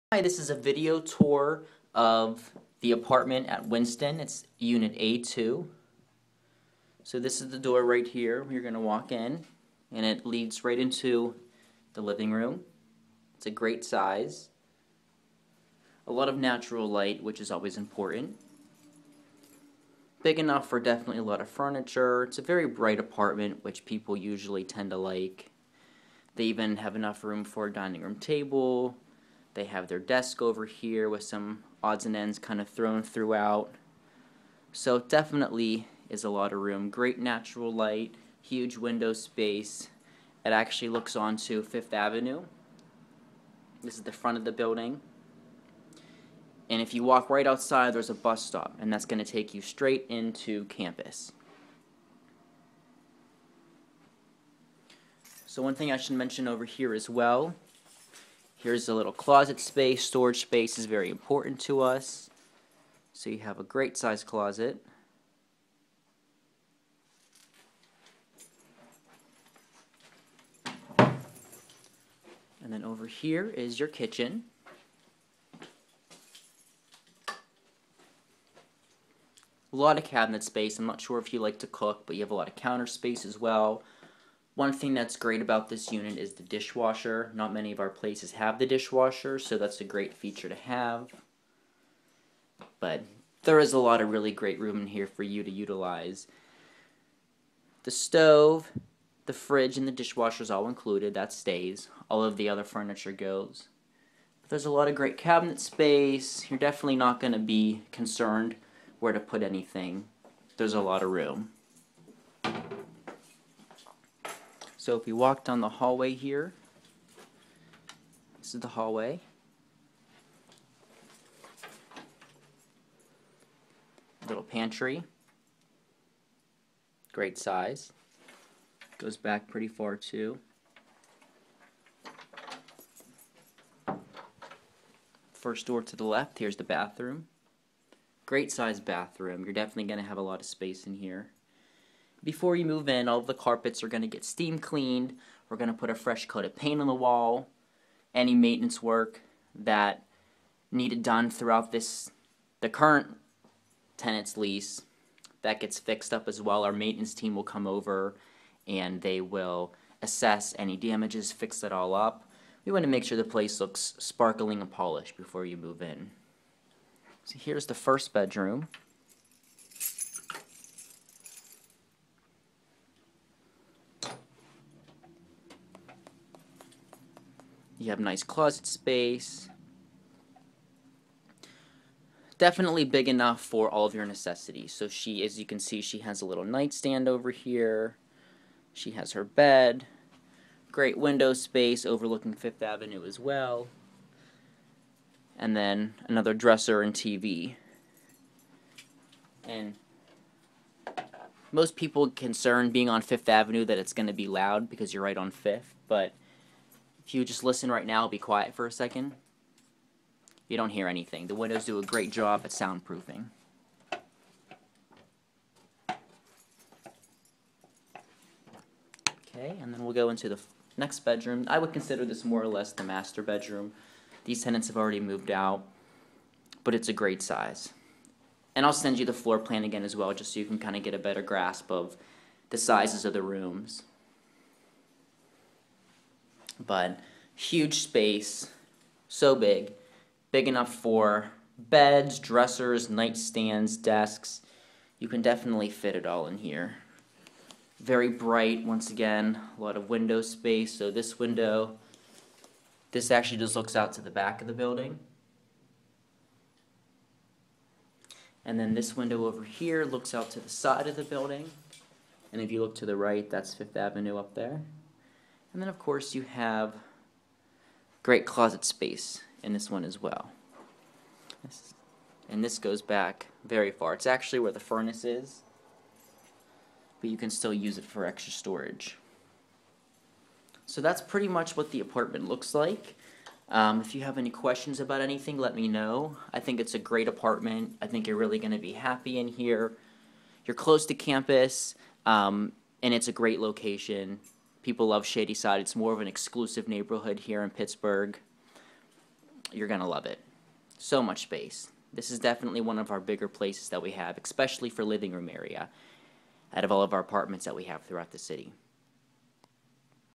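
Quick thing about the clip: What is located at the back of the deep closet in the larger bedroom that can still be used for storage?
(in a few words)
The furnace.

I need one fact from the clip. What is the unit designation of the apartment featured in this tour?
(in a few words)
A2.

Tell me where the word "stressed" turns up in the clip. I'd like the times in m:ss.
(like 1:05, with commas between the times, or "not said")
not said.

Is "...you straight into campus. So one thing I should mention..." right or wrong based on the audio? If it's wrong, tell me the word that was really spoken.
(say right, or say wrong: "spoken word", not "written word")
right.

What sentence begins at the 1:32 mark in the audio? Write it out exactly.
But there is a lot of really great room in here for you to utilize.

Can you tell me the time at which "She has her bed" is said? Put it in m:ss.
3:08.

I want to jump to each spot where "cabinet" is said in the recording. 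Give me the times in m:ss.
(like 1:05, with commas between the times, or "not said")
1:20, 1:45.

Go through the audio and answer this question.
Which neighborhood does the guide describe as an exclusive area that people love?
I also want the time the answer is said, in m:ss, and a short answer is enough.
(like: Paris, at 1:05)
Shadyside, at 4:55.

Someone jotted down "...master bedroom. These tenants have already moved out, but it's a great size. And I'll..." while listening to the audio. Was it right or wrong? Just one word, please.
right.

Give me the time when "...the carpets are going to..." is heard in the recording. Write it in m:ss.
2:23.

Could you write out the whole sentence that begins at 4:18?
And then this window over here looks out to the side of the building.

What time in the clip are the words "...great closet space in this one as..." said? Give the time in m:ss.
4:28.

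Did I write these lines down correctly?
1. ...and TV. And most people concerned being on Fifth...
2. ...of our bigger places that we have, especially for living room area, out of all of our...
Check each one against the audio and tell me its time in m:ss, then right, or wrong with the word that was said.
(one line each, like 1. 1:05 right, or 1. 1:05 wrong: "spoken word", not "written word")
1. 3:16 right
2. 5:02 right.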